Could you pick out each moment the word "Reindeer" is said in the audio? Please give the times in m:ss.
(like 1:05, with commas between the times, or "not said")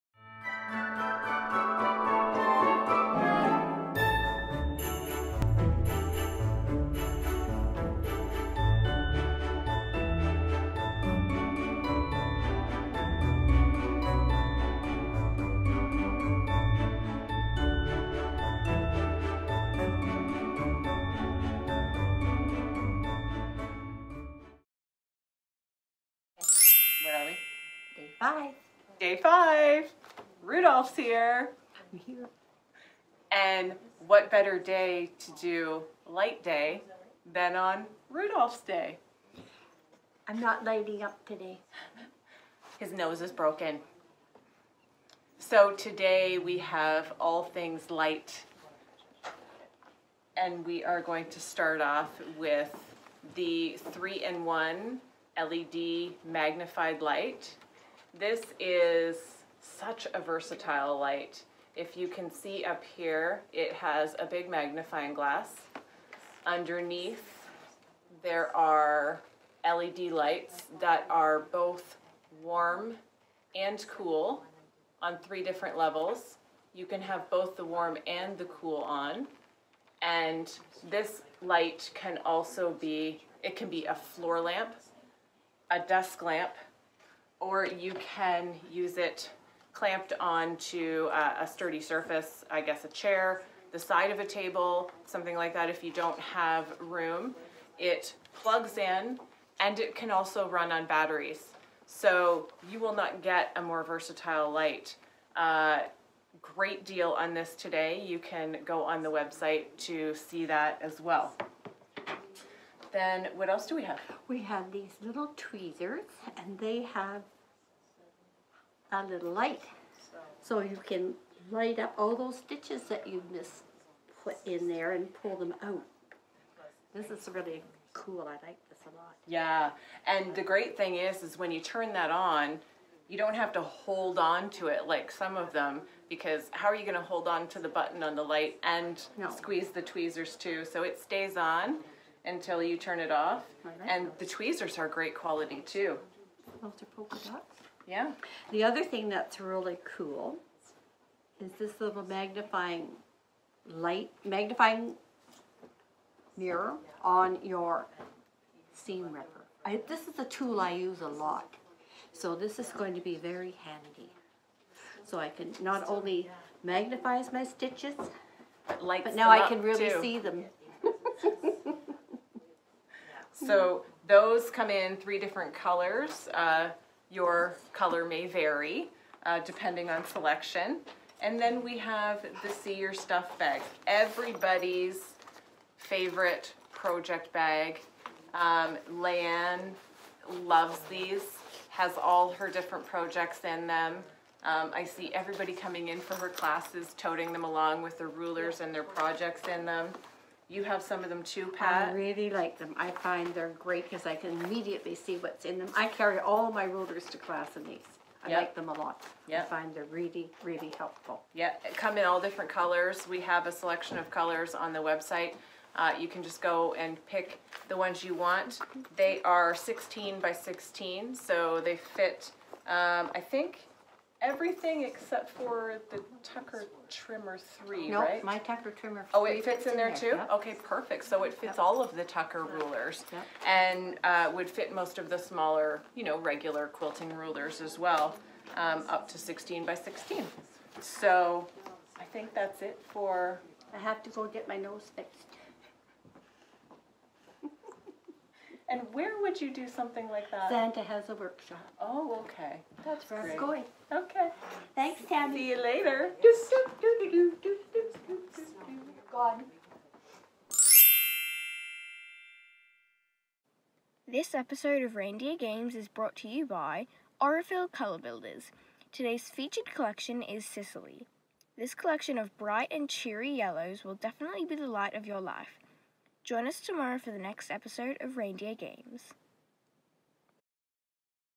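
4:24, 4:38.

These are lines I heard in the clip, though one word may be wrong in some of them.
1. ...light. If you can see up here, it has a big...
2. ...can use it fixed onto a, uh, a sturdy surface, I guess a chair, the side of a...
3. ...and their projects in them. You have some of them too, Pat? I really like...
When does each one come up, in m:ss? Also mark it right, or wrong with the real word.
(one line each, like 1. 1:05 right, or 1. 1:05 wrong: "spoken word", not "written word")
1. 1:00 right
2. 1:27 wrong: "clamped", not "fixed"
3. 3:18 right.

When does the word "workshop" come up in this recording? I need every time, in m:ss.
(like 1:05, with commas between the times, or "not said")
4:11.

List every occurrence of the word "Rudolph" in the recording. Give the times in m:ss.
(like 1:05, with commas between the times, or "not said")
0:30, 0:38.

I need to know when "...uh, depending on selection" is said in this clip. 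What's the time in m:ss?
2:59.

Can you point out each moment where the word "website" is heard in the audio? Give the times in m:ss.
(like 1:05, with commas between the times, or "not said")
1:49, 3:34.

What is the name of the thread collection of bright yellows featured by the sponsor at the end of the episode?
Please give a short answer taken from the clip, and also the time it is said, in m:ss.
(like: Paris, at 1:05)
Sicily, at 4:30.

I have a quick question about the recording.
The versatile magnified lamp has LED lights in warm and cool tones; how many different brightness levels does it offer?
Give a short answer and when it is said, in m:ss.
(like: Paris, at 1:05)
3, at 1:15.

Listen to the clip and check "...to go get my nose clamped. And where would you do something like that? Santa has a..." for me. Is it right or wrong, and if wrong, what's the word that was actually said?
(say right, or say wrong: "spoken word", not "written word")
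wrong: "fixed", not "clamped".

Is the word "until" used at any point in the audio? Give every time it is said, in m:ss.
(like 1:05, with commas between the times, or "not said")
2:22.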